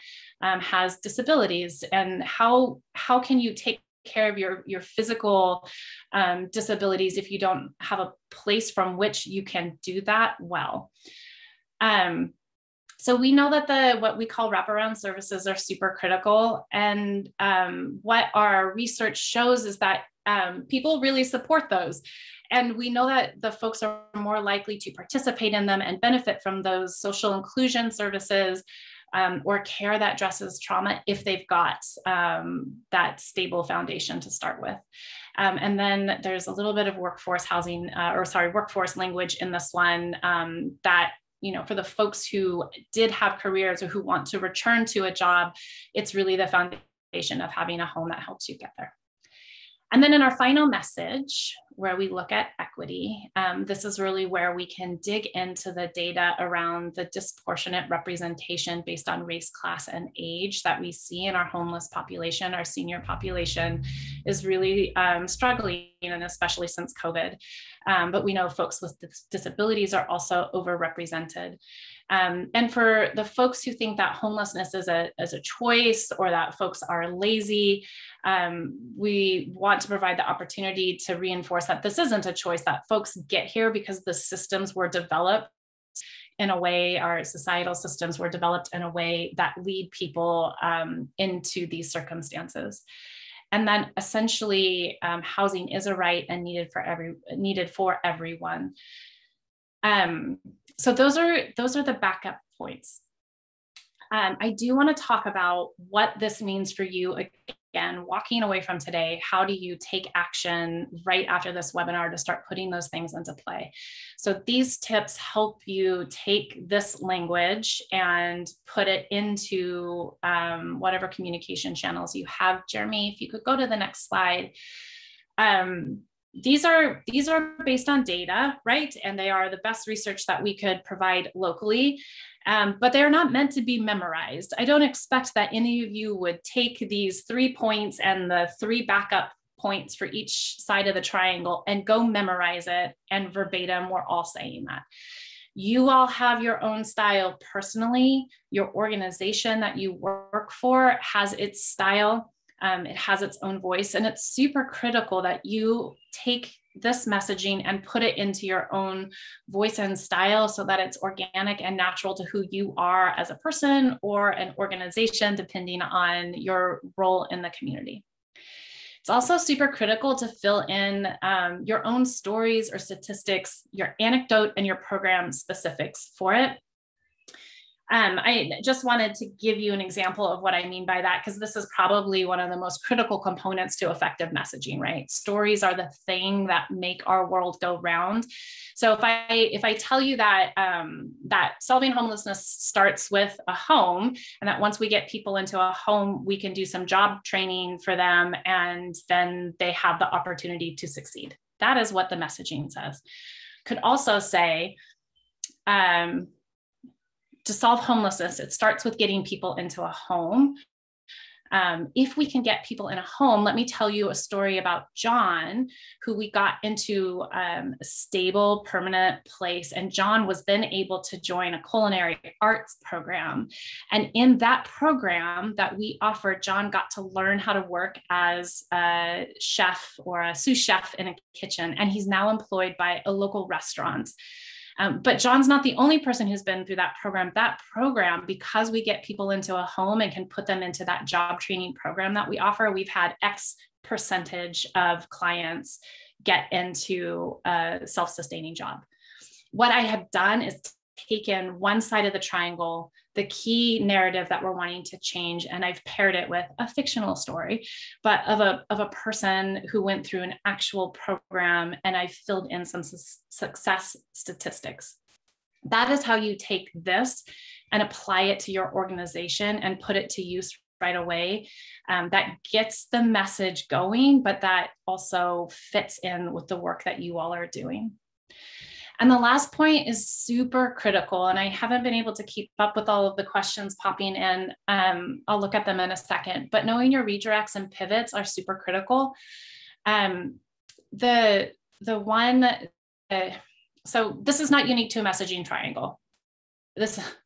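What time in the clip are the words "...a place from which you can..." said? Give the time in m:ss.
0:07.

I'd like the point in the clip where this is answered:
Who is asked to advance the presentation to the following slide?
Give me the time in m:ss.
2:02.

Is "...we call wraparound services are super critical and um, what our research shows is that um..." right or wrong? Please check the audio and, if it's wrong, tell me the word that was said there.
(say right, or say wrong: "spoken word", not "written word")
right.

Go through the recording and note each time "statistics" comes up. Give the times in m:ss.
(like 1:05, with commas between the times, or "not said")
2:52, 4:24.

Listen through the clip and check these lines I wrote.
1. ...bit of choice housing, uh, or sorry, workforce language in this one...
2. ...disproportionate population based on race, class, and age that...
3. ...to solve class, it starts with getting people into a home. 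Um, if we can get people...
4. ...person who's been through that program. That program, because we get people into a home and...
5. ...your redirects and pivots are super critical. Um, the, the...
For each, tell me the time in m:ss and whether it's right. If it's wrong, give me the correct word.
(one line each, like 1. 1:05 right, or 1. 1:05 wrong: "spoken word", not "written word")
1. 0:36 wrong: "workforce", not "choice"
2. 0:57 wrong: "representation", not "population"
3. 3:27 wrong: "homelessness", not "class"
4. 3:55 right
5. 4:46 right.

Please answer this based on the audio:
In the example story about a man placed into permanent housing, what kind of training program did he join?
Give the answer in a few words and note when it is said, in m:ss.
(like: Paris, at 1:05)
culinary arts program, at 3:41.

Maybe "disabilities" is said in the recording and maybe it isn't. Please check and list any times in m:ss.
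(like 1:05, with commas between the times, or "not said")
0:00, 0:06, 1:09.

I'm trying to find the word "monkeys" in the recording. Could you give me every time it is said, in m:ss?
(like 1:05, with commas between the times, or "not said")
not said.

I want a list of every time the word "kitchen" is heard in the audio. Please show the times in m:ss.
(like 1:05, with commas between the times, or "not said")
3:51.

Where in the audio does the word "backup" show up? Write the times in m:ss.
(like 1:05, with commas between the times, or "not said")
1:41, 2:18.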